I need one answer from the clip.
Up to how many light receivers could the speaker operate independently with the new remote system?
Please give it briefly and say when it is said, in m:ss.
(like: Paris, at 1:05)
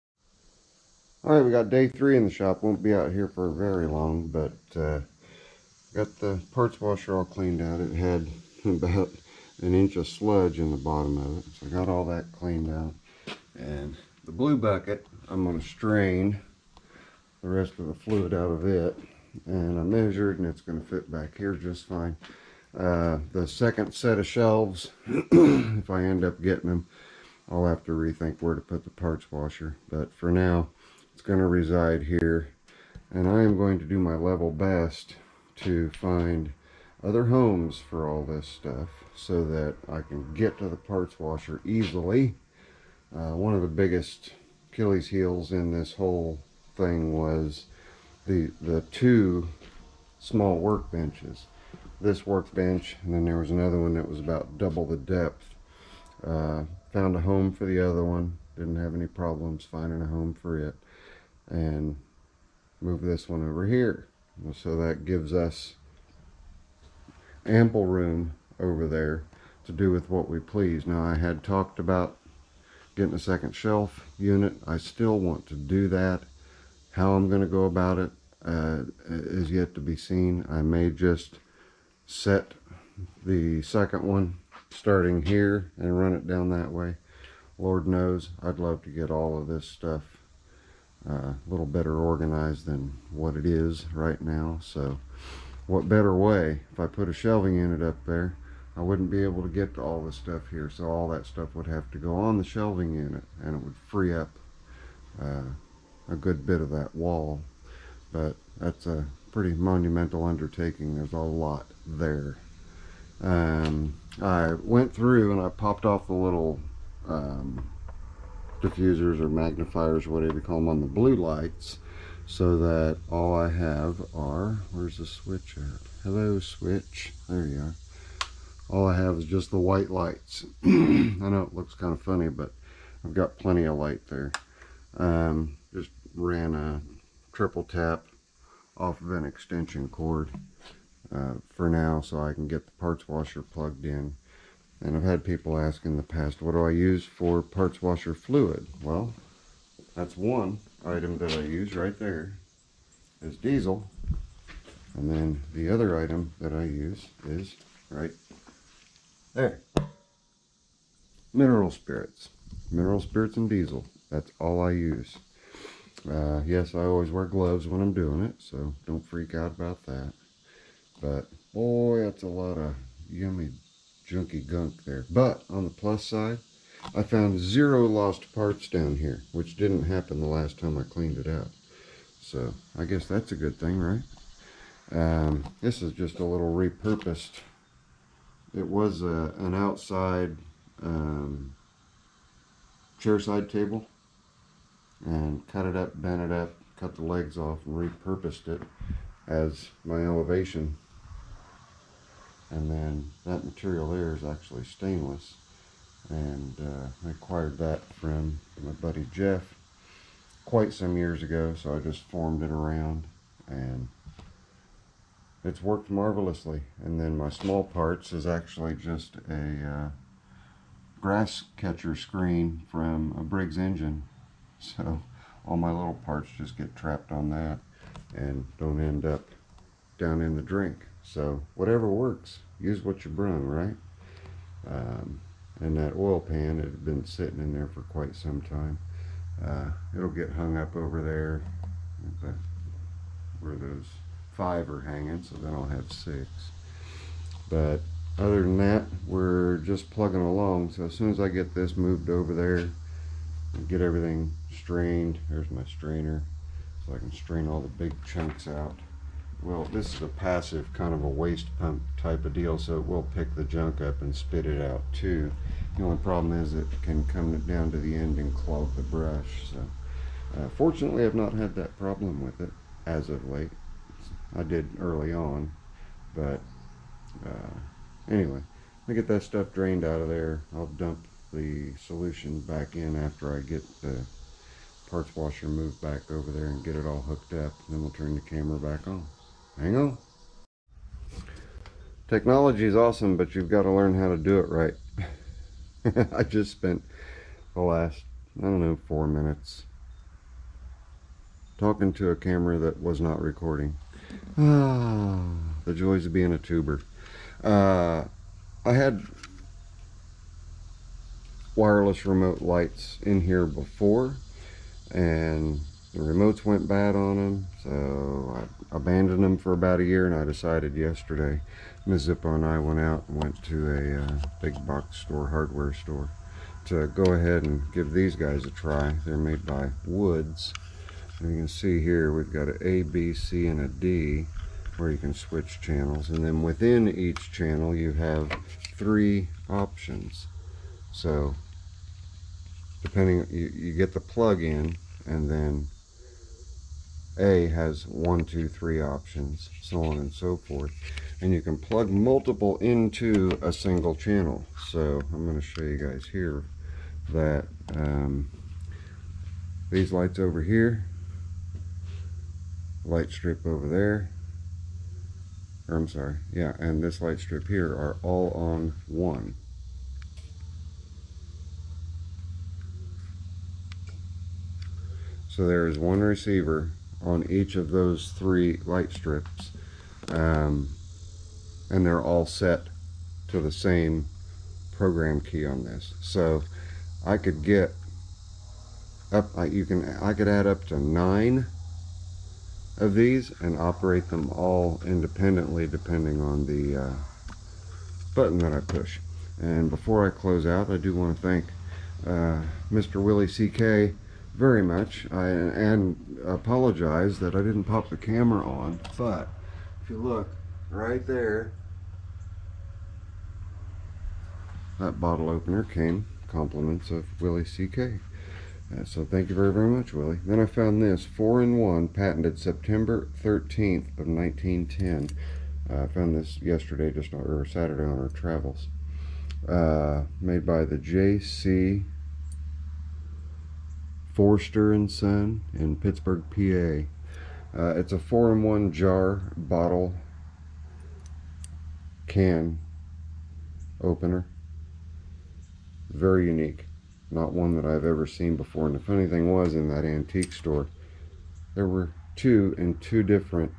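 9, at 6:30.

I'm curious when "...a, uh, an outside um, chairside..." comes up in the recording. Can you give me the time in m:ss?
3:09.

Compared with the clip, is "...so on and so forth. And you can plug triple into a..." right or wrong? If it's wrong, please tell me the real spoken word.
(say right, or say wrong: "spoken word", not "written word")
wrong: "multiple", not "triple".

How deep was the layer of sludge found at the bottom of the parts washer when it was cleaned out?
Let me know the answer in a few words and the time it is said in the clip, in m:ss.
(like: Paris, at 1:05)
about an inch, at 0:08.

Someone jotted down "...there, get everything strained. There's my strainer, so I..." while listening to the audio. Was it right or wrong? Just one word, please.
right.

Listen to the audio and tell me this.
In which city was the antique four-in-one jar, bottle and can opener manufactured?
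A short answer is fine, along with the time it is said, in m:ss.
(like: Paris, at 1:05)
Pittsburgh, at 7:15.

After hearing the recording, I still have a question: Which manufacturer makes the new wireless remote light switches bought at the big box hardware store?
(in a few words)
Woods.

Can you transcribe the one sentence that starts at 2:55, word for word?
But on the plus side, I found zero lost parts down here, which didn't happen the last time I cleaned it out.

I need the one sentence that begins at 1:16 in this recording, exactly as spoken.
How I'm going to go about it uh, is yet to be seen.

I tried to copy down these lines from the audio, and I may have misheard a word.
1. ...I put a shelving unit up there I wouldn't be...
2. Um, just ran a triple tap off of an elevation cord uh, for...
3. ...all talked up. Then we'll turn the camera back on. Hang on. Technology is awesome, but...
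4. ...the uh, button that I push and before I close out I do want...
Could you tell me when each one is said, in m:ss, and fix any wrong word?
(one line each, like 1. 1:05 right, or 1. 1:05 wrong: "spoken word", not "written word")
1. 1:36 right
2. 2:14 wrong: "extension", not "elevation"
3. 4:46 wrong: "hooked", not "talked"
4. 6:36 right.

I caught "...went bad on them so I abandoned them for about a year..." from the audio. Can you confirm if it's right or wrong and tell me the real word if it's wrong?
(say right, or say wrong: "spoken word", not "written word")
right.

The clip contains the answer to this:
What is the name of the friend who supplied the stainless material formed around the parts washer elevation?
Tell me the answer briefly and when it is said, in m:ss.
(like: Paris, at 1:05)
Jeff, at 3:29.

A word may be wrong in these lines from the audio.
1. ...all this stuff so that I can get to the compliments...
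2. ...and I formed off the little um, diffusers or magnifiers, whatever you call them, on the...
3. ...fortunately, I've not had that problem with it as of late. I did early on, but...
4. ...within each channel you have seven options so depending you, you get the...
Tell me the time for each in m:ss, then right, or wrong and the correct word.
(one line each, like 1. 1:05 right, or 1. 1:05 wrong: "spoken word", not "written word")
1. 0:38 wrong: "parts", not "compliments"
2. 1:55 wrong: "popped", not "formed"
3. 4:30 right
4. 5:36 wrong: "three", not "seven".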